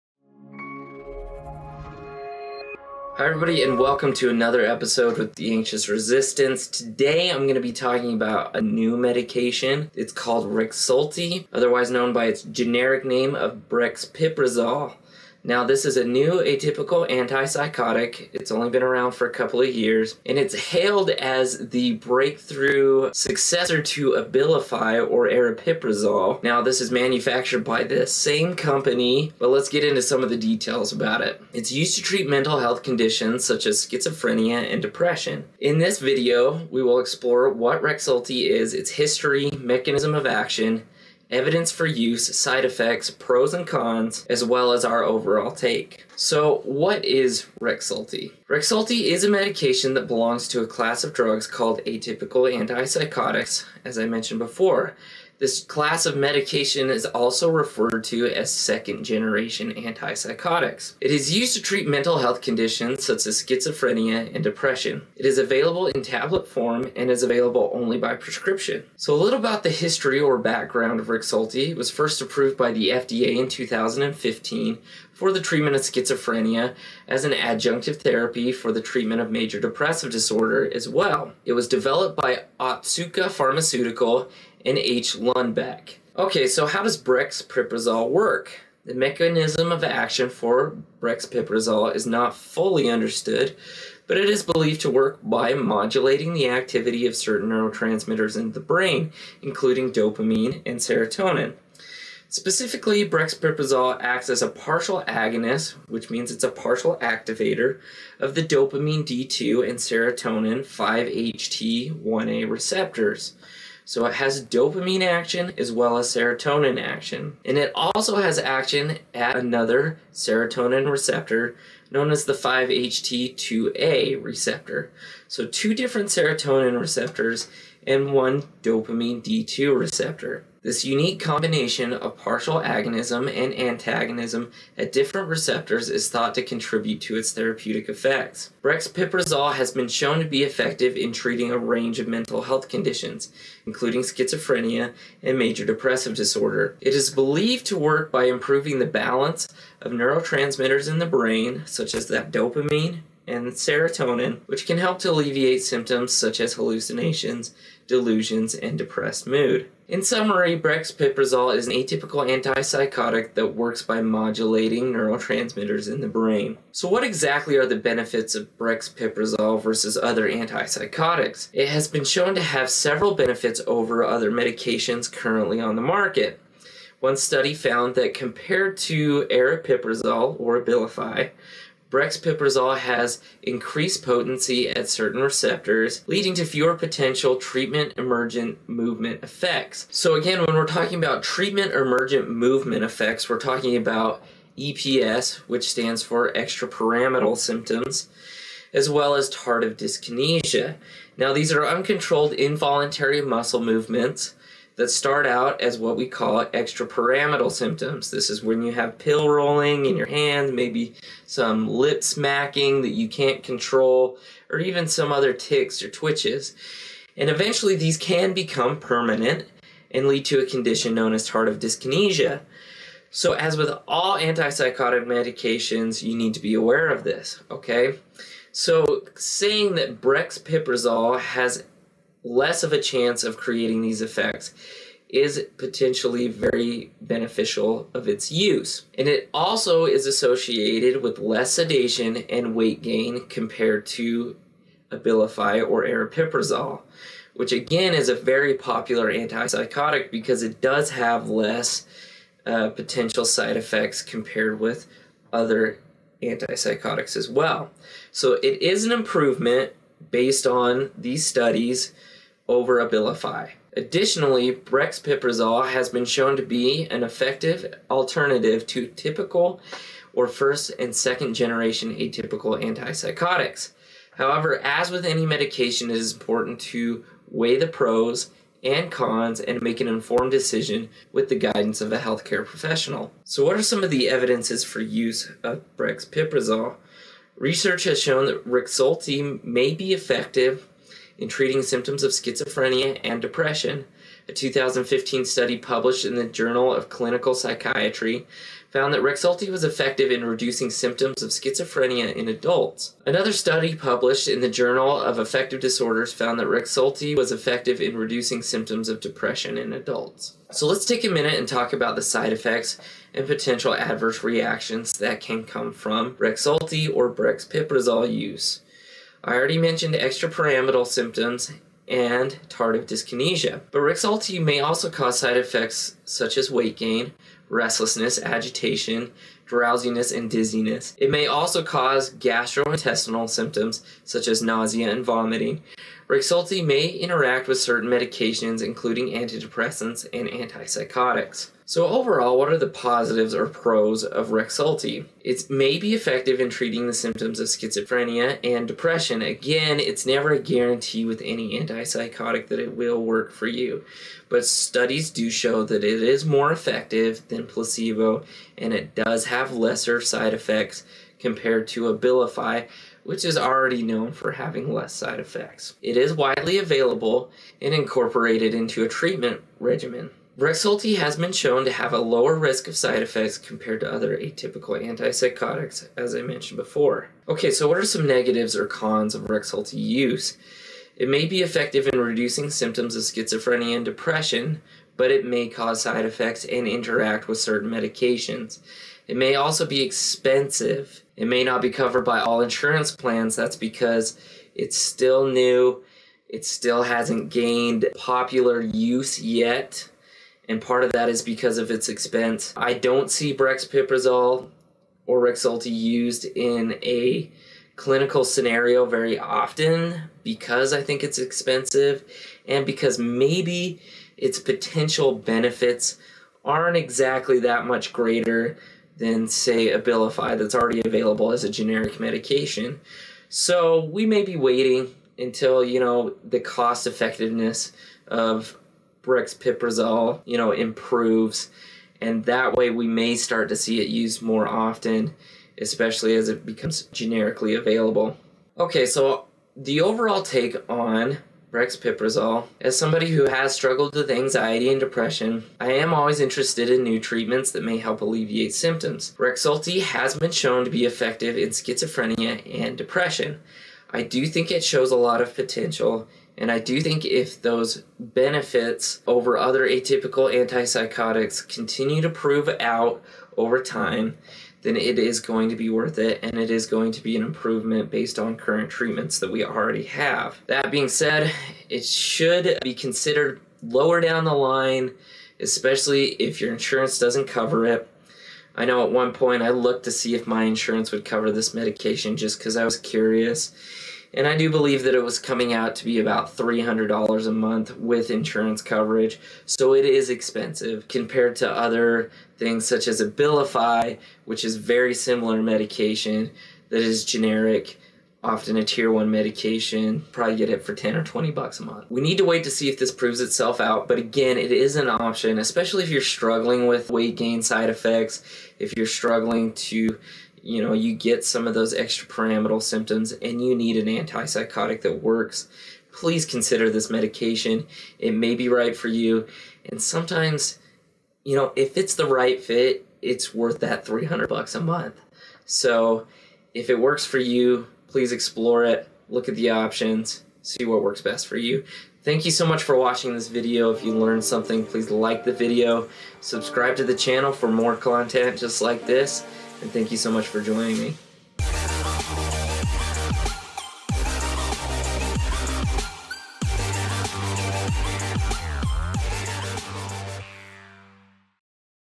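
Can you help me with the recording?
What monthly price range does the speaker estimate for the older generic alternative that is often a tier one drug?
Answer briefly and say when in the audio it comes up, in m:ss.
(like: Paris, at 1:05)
10 or 20 dollars, at 8:20.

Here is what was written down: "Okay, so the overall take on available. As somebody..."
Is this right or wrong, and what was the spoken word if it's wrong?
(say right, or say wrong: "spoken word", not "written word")
wrong: "brexpiprazole", not "available".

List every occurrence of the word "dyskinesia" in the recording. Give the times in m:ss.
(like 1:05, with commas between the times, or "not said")
3:19, 3:41, 5:22.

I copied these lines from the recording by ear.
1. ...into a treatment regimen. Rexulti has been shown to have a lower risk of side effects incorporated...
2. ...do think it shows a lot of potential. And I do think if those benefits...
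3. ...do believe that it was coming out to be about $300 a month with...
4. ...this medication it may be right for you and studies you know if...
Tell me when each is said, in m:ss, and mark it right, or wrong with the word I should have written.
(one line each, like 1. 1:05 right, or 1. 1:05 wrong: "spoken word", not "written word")
1. 6:08 wrong: "compared", not "incorporated"
2. 7:34 right
3. 8:04 right
4. 8:36 wrong: "sometimes", not "studies".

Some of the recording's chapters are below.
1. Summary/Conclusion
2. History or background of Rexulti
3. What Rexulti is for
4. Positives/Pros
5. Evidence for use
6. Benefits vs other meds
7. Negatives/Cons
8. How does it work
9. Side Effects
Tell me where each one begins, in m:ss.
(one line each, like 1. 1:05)
1. 7:21
2. 1:09
3. 0:32
4. 5:41
5. 4:43
6. 2:50
7. 6:18
8. 1:26
9. 5:12.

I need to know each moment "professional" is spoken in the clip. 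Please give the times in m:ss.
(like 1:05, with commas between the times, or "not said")
4:42.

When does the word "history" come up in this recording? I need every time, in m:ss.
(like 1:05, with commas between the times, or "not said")
0:38, 1:09.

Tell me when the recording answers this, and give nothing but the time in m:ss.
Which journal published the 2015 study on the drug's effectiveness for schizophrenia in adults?
4:56.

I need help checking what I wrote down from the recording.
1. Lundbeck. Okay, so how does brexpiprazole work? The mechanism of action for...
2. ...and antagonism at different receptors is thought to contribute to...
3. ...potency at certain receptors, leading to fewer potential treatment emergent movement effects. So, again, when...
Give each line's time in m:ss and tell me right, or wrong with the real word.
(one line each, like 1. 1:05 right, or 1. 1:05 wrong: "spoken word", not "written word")
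1. 1:25 right
2. 2:13 right
3. 3:04 right.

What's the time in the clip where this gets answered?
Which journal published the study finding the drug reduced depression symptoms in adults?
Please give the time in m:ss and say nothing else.
5:04.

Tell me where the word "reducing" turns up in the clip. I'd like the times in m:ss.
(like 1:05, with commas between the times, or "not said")
5:00, 5:07, 6:21.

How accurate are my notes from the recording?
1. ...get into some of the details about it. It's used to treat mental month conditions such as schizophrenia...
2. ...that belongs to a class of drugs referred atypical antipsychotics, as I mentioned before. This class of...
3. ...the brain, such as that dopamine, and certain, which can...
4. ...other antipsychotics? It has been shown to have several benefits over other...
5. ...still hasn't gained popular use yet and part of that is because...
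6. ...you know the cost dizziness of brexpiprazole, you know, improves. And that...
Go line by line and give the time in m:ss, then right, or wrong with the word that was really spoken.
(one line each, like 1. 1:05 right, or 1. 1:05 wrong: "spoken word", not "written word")
1. 0:29 wrong: "health", not "month"
2. 0:49 wrong: "called", not "referred"
3. 2:30 wrong: "serotonin", not "certain"
4. 2:49 right
5. 6:36 right
6. 7:05 wrong: "effectiveness", not "dizziness".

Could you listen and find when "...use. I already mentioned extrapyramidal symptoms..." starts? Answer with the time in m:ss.
5:18.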